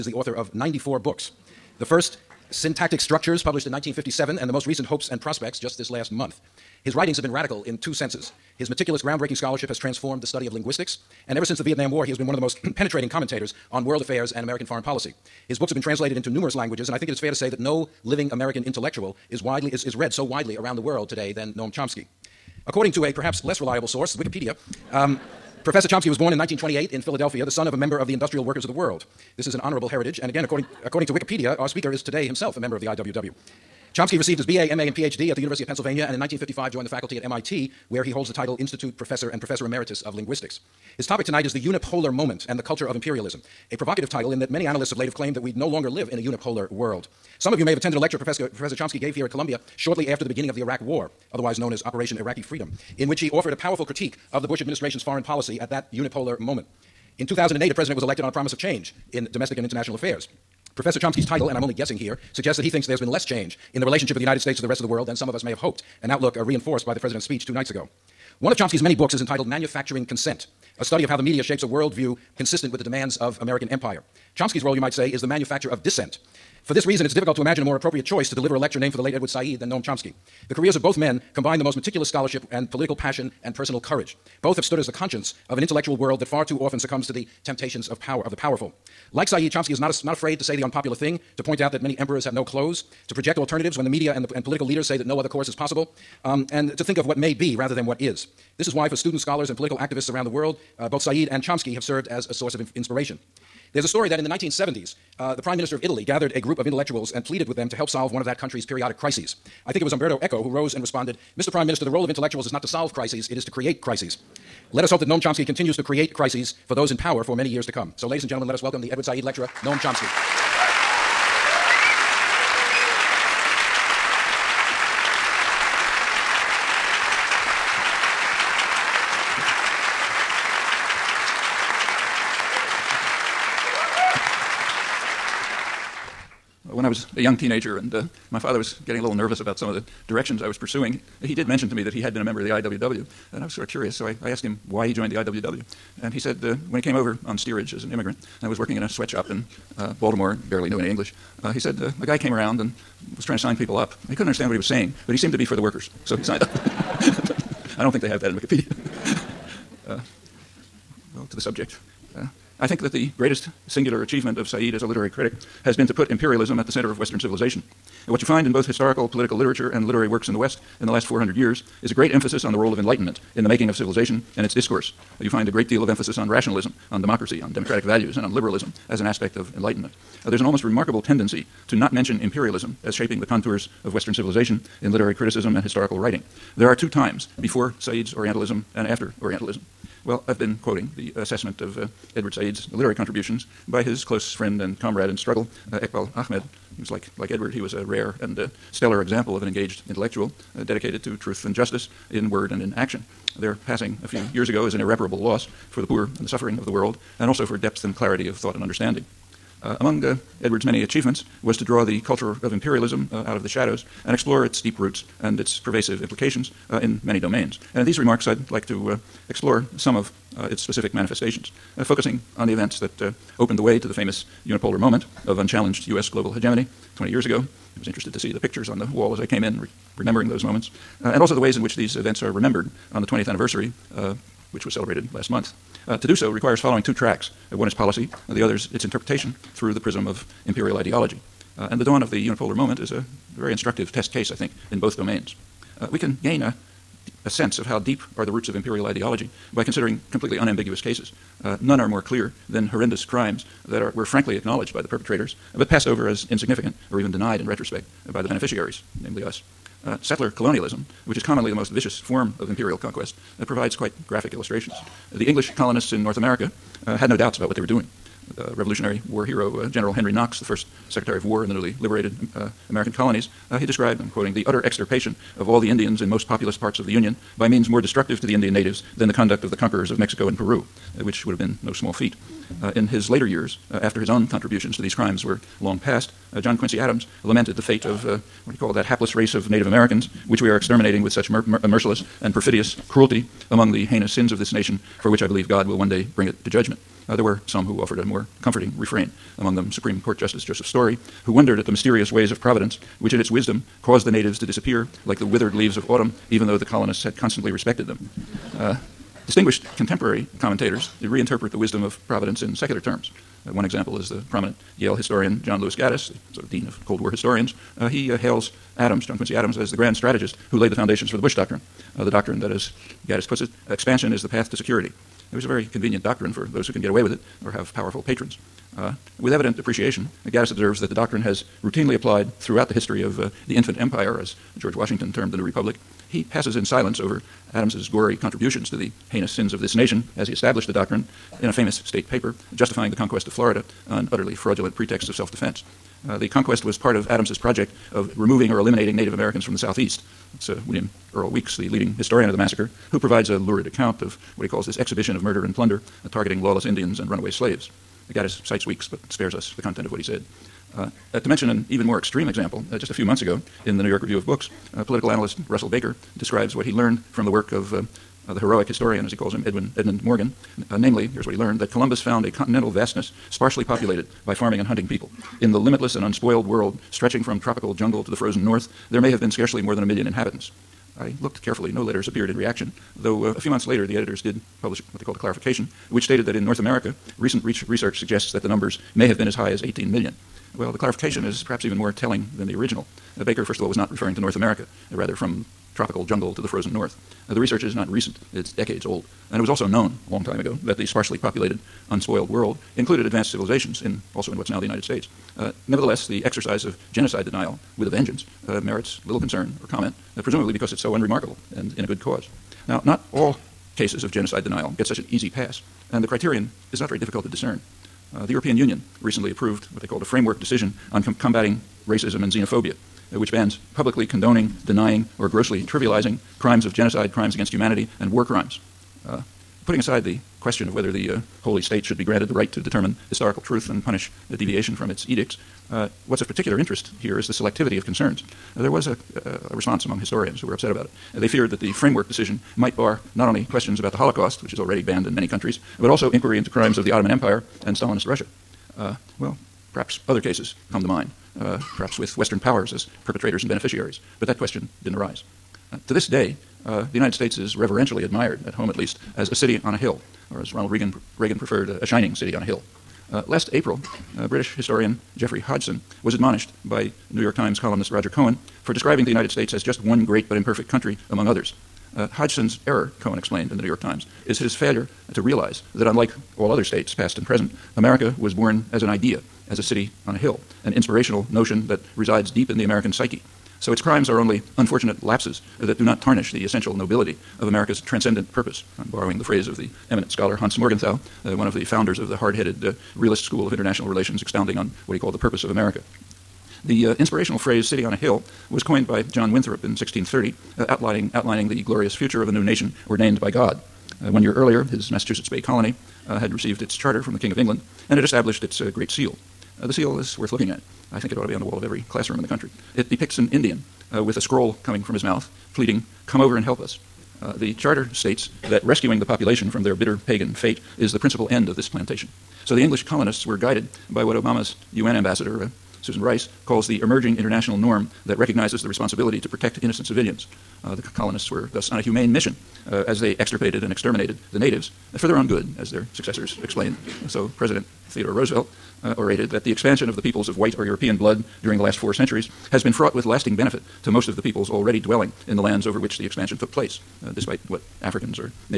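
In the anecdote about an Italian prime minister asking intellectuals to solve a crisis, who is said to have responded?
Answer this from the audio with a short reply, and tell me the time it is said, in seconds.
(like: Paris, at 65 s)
Umberto Eco, at 109 s.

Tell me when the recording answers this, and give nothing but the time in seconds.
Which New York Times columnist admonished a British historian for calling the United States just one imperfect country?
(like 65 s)
467 s.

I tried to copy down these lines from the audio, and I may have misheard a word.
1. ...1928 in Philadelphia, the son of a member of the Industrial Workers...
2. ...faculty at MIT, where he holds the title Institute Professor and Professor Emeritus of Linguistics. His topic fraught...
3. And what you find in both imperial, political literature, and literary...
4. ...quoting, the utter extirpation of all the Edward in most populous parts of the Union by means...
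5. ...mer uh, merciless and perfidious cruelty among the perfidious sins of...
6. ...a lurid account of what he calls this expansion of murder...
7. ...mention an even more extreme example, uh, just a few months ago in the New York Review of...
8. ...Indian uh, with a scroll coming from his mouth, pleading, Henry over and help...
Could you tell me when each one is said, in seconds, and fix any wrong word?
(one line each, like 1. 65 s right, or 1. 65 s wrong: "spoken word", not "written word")
1. 26 s right
2. 36 s wrong: "tonight", not "fraught"
3. 168 s wrong: "historical", not "imperial"
4. 274 s wrong: "Indians", not "Edward"
5. 291 s wrong: "heinous", not "perfidious"
6. 353 s wrong: "exhibition", not "expansion"
7. 361 s right
8. 513 s wrong: "Come", not "Henry".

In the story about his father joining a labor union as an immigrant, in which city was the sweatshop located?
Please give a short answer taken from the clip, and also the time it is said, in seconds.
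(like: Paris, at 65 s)
Baltimore, at 150 s.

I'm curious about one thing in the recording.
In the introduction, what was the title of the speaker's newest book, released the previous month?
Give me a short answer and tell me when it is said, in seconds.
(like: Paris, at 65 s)
Hopes and Prospects, at 4 s.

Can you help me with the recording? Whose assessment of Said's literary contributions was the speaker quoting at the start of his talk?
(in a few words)
Eqbal Ahmad.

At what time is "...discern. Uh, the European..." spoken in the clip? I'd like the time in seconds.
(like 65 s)
417 s.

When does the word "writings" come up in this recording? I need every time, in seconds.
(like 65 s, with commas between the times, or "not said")
6 s, 185 s.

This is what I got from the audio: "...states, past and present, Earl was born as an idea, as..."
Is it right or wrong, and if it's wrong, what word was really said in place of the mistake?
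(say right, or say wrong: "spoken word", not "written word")
wrong: "America", not "Earl".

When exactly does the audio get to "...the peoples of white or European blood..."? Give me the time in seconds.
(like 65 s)
539 s.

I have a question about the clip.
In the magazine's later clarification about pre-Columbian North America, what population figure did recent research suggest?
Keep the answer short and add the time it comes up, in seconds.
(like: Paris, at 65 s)
18 million, at 389 s.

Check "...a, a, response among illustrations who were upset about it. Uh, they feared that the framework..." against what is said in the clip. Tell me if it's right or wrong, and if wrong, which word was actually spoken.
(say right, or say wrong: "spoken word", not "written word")
wrong: "historians", not "illustrations".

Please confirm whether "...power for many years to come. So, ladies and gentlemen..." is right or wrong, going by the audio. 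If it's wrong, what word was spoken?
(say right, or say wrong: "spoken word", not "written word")
right.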